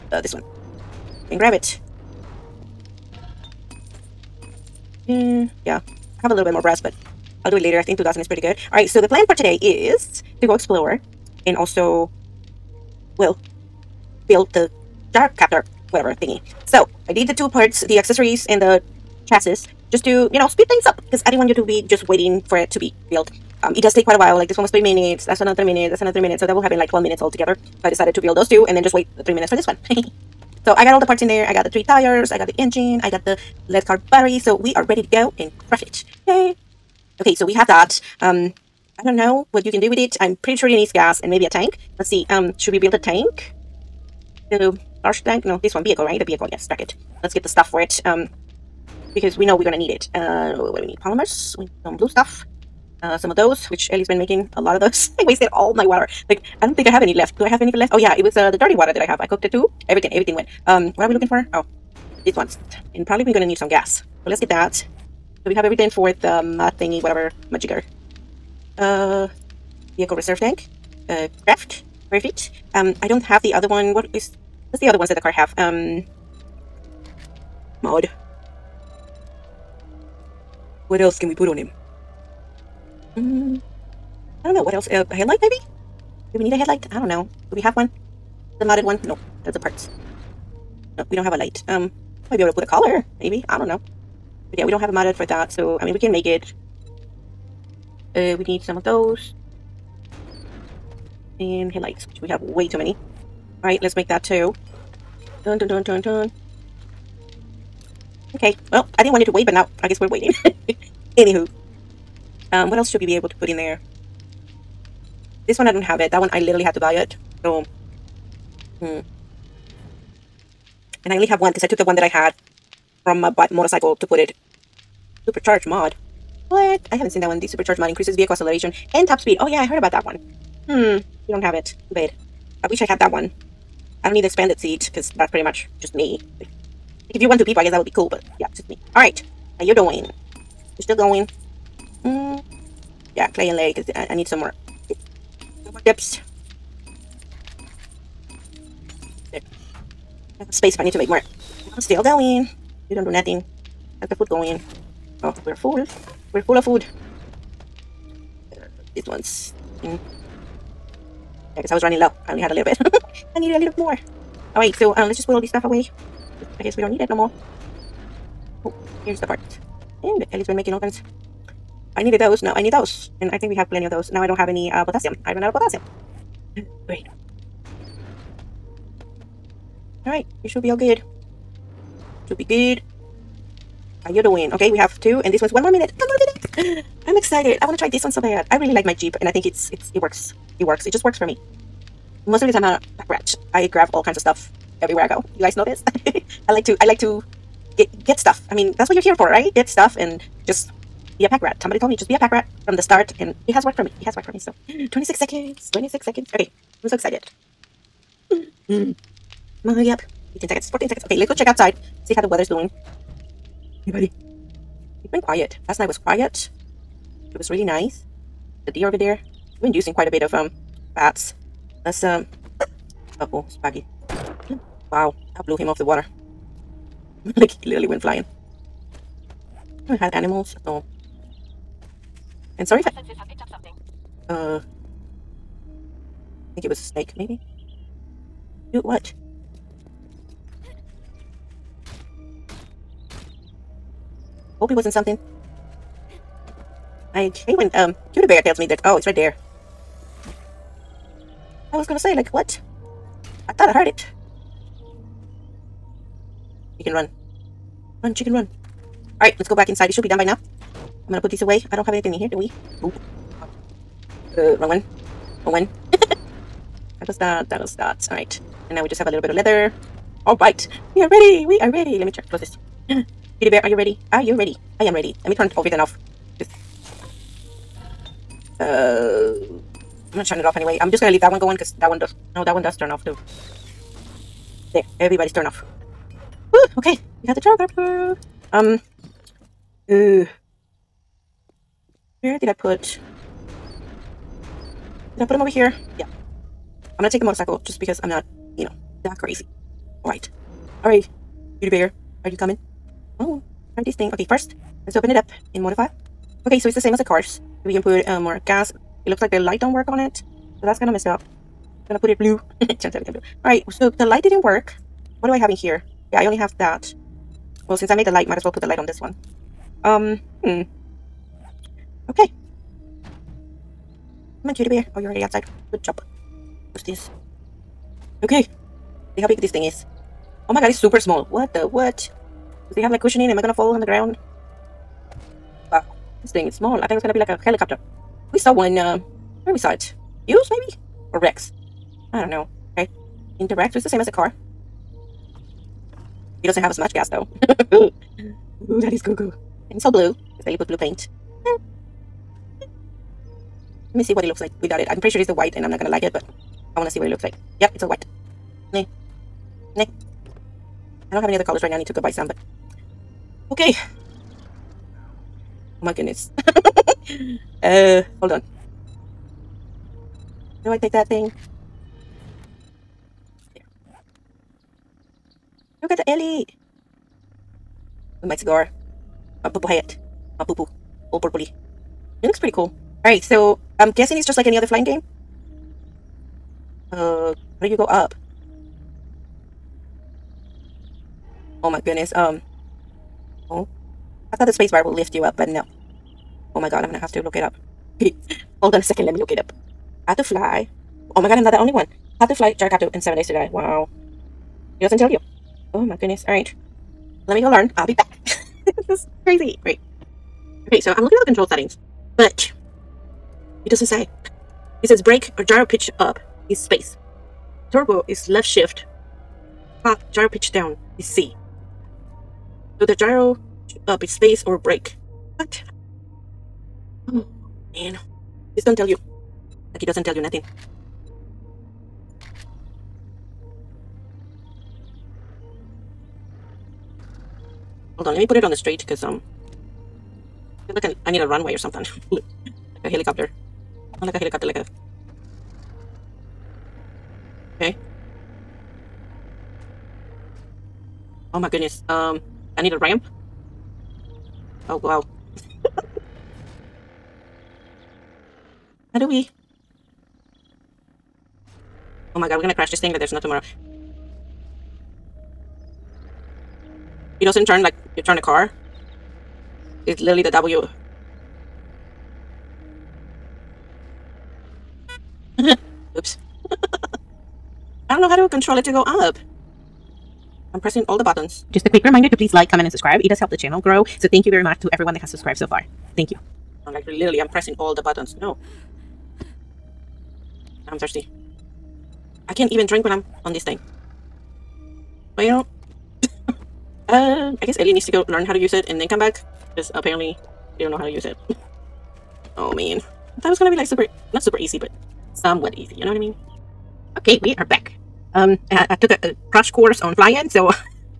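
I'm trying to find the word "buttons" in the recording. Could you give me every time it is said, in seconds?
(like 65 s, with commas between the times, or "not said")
481 s, 487 s.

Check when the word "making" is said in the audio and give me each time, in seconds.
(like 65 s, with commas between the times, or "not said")
54 s, 170 s.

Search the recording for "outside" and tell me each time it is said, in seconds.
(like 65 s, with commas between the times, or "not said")
211 s, 325 s.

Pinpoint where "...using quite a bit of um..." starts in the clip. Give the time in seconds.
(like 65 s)
219 s.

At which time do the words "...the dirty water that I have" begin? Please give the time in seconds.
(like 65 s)
58 s.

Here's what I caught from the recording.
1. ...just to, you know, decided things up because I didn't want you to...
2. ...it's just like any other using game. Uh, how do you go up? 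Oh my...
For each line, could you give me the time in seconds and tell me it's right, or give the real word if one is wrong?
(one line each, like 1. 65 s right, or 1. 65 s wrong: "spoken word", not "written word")
1. 19 s wrong: "speed", not "decided"
2. 384 s wrong: "flying", not "using".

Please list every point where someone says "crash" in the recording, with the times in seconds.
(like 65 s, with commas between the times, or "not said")
462 s, 509 s.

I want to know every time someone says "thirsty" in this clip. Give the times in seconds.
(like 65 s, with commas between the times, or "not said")
490 s.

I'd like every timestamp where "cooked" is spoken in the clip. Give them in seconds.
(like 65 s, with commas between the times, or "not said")
59 s.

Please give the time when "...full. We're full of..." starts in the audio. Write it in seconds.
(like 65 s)
155 s.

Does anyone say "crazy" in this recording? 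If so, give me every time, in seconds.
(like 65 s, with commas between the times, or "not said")
299 s, 409 s.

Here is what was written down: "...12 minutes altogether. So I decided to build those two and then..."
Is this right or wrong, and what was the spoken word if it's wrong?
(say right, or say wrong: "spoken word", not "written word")
right.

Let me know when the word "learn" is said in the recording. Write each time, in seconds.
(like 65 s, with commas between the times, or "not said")
407 s, 498 s.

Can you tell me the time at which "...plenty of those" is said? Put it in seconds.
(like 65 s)
173 s.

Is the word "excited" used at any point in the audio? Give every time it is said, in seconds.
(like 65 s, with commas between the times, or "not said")
187 s, 206 s.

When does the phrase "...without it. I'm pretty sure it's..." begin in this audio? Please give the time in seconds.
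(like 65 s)
354 s.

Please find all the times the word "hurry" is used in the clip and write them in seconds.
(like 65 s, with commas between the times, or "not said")
209 s.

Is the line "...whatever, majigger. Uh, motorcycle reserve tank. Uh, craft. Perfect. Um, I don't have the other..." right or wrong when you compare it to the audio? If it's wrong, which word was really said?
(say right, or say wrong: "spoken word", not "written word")
wrong: "vehicle", not "motorcycle".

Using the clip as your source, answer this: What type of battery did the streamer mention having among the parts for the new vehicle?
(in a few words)
lead car battery.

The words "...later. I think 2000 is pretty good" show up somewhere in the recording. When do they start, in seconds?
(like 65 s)
7 s.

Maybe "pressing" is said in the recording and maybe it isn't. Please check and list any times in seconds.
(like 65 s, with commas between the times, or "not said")
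480 s, 487 s.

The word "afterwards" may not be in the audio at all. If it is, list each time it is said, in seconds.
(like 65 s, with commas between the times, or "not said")
not said.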